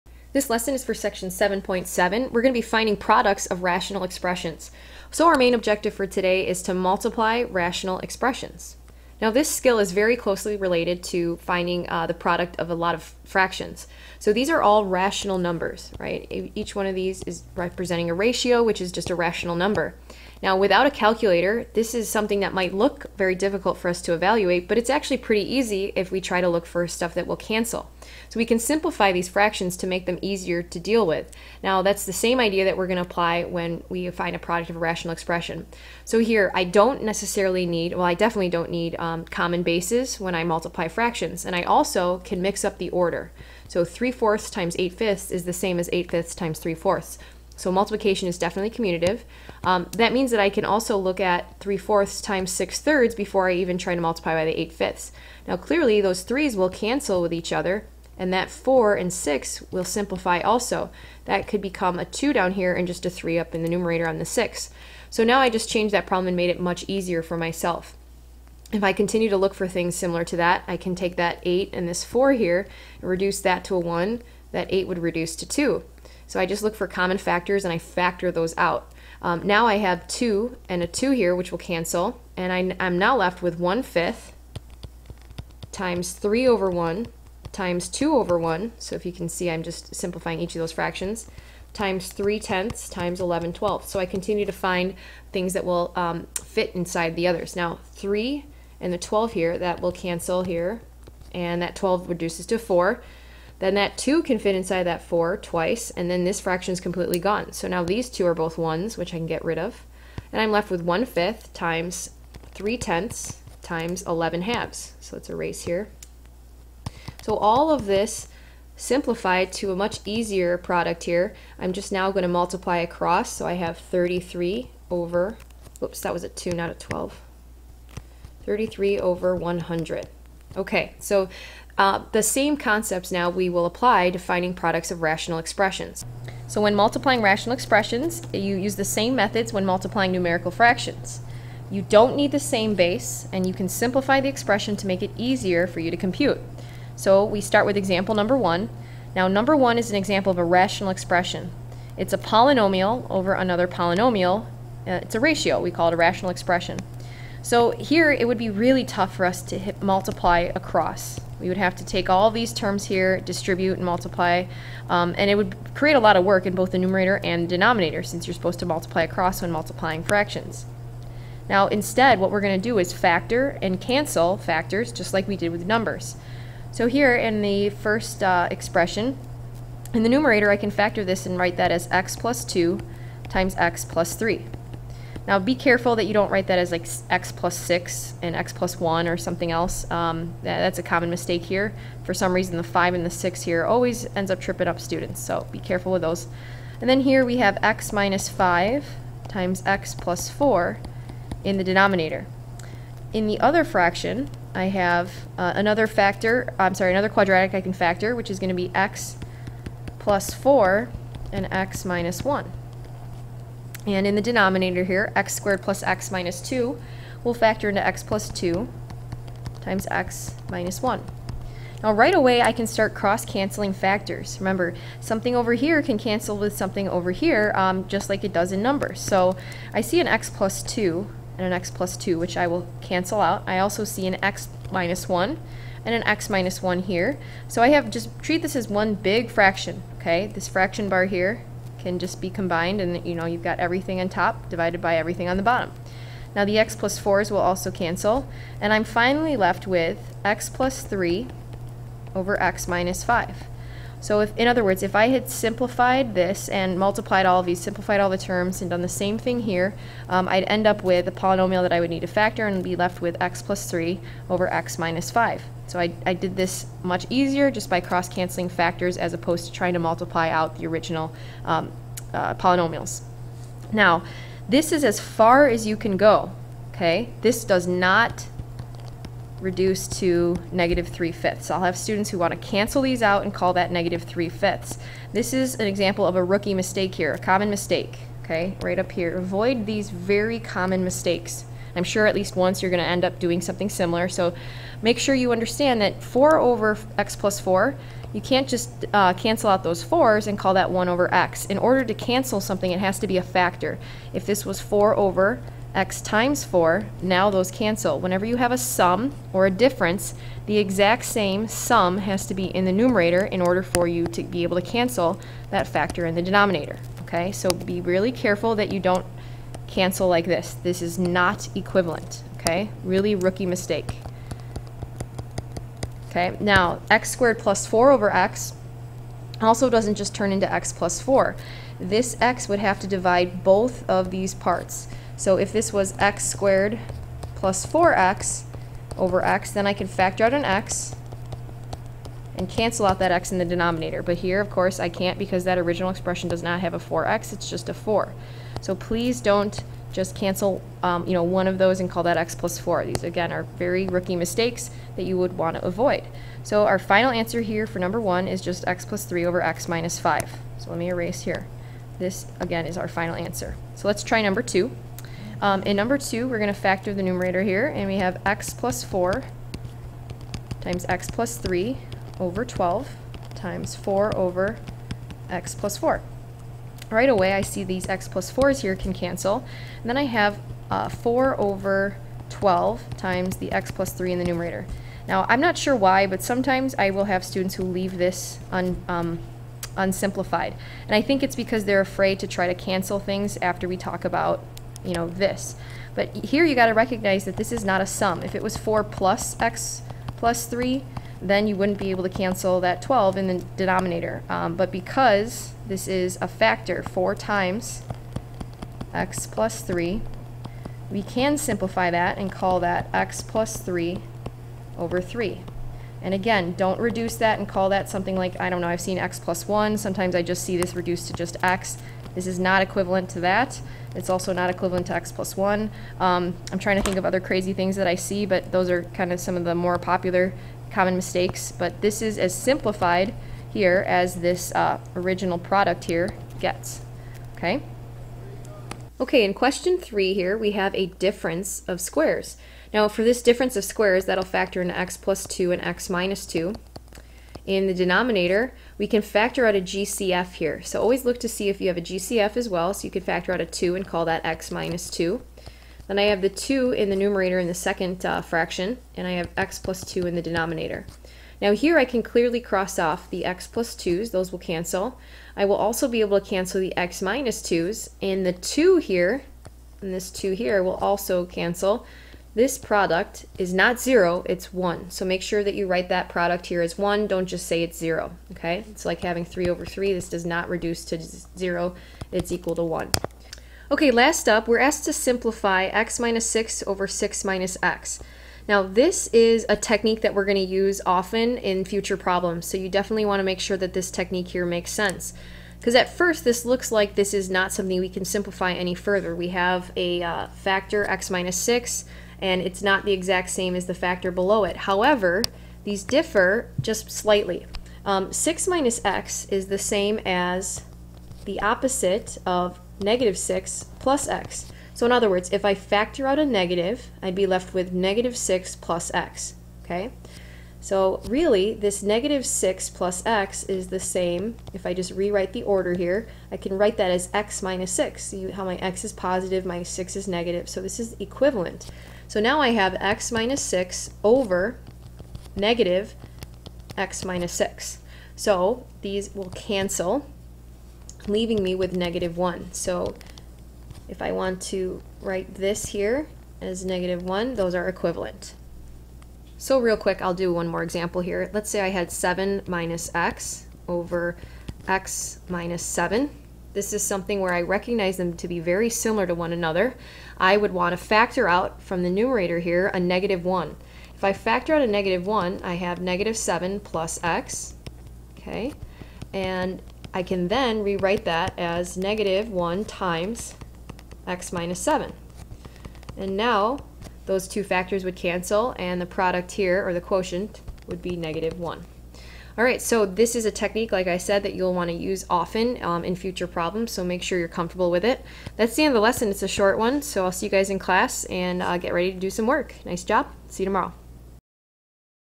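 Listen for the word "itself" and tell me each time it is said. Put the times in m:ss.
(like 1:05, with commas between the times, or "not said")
not said.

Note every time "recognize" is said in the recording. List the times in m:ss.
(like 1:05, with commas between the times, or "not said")
6:36, 9:17.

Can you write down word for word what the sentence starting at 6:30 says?
And I think it's because they're afraid to try to cancel things after we talk about you know, this.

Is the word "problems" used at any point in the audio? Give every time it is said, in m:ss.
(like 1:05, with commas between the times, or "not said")
1:06, 8:11, 9:46.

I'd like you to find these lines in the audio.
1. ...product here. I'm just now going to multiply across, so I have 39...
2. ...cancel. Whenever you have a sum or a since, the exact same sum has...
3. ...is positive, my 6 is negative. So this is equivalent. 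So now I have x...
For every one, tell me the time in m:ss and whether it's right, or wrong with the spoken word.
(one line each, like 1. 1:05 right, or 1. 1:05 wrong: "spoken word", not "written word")
1. 2:00 wrong: "33", not "39"
2. 5:07 wrong: "difference", not "since"
3. 8:48 right.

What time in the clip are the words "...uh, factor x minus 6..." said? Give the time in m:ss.
8:20.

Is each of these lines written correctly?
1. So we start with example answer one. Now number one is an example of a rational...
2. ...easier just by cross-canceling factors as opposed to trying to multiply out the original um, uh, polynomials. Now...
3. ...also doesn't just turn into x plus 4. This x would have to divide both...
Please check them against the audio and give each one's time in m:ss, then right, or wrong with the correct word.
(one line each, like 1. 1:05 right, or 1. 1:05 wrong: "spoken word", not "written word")
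1. 2:26 wrong: "number", not "answer"
2. 4:27 right
3. 5:29 right.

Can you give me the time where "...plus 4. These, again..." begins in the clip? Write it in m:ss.
5:52.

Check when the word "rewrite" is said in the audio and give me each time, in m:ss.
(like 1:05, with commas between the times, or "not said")
8:44, 9:30.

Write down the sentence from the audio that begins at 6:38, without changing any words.
If it was 4 plus x plus 3, then you wouldn't be able to cancel that 12 in the denominator.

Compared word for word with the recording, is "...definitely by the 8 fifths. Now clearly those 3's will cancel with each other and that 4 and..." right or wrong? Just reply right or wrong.
wrong.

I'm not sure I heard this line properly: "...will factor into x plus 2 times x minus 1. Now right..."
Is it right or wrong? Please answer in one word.
right.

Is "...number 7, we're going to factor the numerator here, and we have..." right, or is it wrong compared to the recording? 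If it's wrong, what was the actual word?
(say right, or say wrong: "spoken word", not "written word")
wrong: "2", not "7".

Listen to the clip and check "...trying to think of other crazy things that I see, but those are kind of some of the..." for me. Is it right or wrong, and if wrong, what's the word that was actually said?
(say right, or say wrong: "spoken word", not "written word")
right.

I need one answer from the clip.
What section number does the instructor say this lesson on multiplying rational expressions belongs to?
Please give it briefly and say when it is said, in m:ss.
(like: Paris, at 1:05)
7.7, at 0:00.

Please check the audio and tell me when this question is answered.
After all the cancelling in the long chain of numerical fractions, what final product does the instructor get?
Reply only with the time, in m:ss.
2:08.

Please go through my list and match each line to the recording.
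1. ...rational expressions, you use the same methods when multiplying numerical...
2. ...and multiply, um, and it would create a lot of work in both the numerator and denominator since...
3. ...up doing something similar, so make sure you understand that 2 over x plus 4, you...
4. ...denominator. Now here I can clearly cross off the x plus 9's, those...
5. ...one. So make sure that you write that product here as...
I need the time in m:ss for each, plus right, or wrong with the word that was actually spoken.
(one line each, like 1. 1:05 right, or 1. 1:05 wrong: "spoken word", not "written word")
1. 2:17 right
2. 2:43 right
3. 4:53 wrong: "4", not "2"
4. 7:40 wrong: "2", not "9"
5. 7:54 right.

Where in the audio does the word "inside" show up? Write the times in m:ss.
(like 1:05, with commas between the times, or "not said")
1:36, 1:44.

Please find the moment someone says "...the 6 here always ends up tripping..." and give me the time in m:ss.
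3:13.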